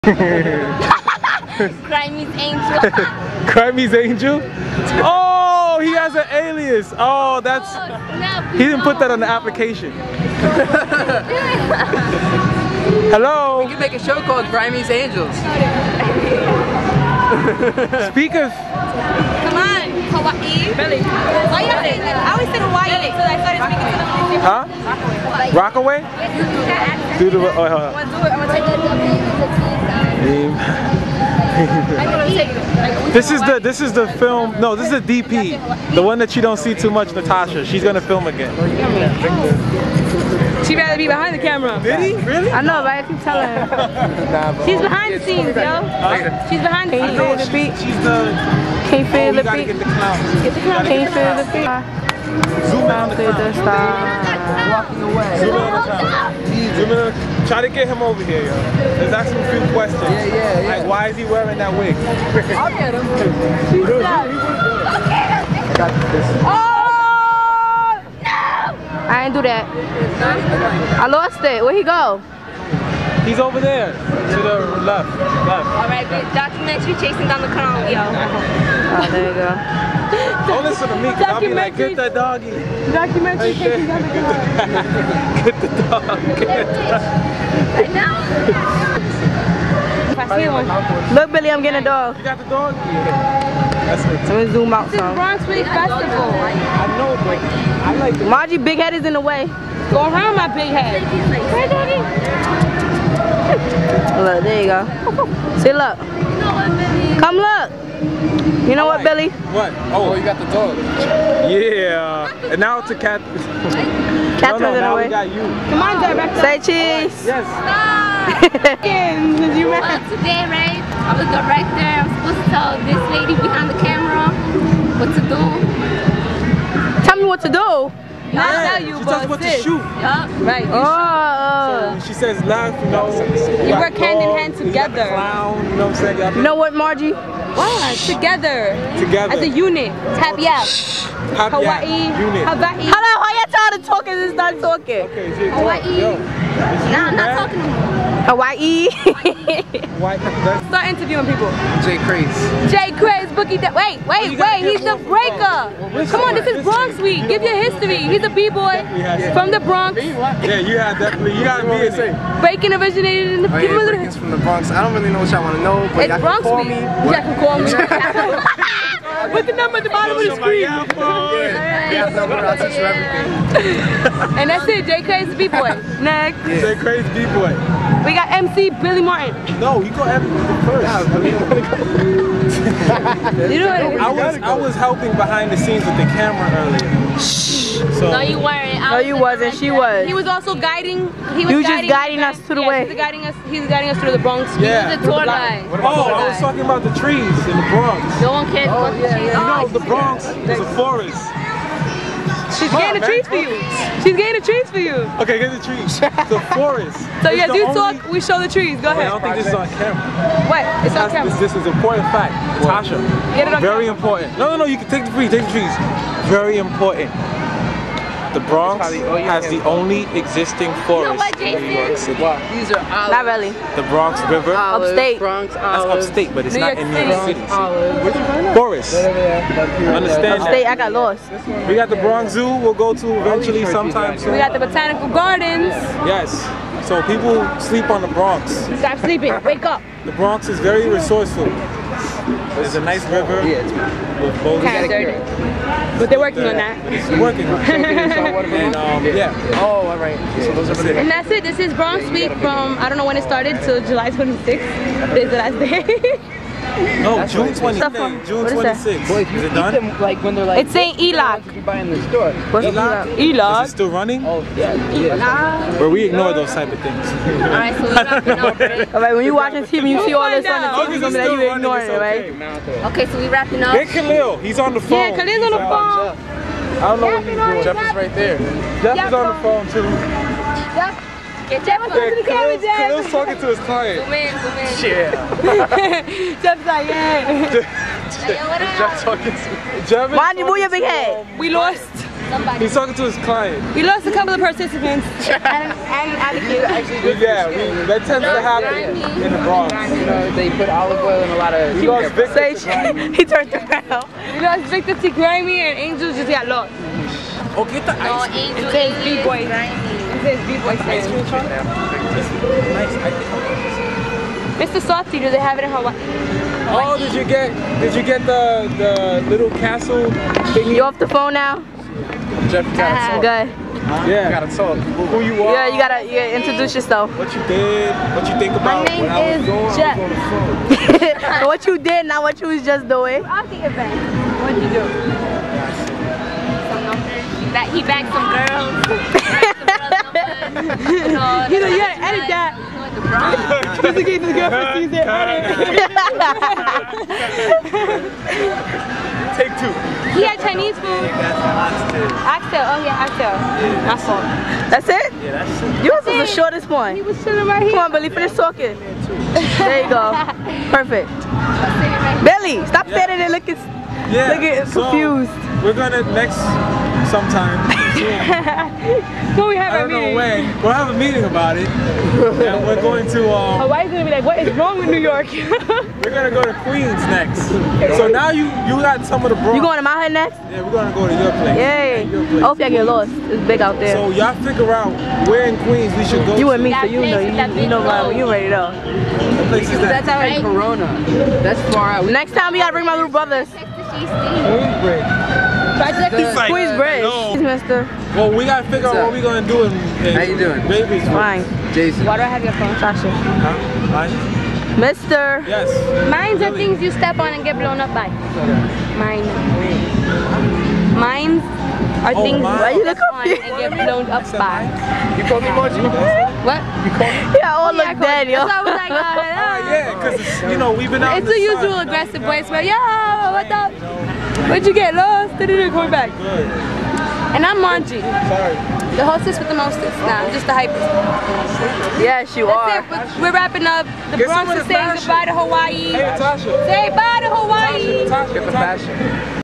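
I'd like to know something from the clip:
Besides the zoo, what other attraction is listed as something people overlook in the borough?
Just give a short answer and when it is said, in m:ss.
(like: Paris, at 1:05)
Botanical Gardens, at 3:54.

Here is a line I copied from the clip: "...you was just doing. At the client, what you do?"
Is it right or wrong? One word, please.
wrong.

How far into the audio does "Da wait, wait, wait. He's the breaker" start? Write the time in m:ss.
2:33.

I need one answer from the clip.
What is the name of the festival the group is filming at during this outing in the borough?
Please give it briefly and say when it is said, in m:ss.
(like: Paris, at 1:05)
Bronx Week Festival, at 1:35.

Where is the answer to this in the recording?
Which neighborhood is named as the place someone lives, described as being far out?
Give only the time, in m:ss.
6:30.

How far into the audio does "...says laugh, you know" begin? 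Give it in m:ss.
2:12.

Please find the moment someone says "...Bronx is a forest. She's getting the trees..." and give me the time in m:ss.
3:19.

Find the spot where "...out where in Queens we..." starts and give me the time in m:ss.
6:24.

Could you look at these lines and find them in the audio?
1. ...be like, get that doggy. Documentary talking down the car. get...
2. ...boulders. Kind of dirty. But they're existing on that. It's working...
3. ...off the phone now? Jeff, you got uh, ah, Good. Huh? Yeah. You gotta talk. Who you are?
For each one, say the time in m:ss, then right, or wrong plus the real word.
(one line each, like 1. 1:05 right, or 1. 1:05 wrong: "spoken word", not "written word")
1. 1:21 wrong: "taking", not "talking"
2. 4:04 wrong: "working", not "existing"
3. 5:20 right.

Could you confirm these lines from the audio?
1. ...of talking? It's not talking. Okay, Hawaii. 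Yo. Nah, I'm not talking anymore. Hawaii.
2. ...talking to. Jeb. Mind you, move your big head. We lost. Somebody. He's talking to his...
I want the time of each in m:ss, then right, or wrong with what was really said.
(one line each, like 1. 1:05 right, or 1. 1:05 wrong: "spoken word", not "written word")
1. 2:23 right
2. 4:49 right.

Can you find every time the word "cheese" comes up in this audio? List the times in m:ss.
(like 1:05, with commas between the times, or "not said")
1:56.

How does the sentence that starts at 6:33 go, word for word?
Queens Try to like squeeze bread.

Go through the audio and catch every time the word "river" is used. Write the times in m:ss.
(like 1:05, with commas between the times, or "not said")
3:44, 4:03.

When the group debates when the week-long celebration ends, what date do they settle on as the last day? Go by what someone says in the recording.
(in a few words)
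June 26.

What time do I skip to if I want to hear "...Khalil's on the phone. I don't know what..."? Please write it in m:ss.
4:35.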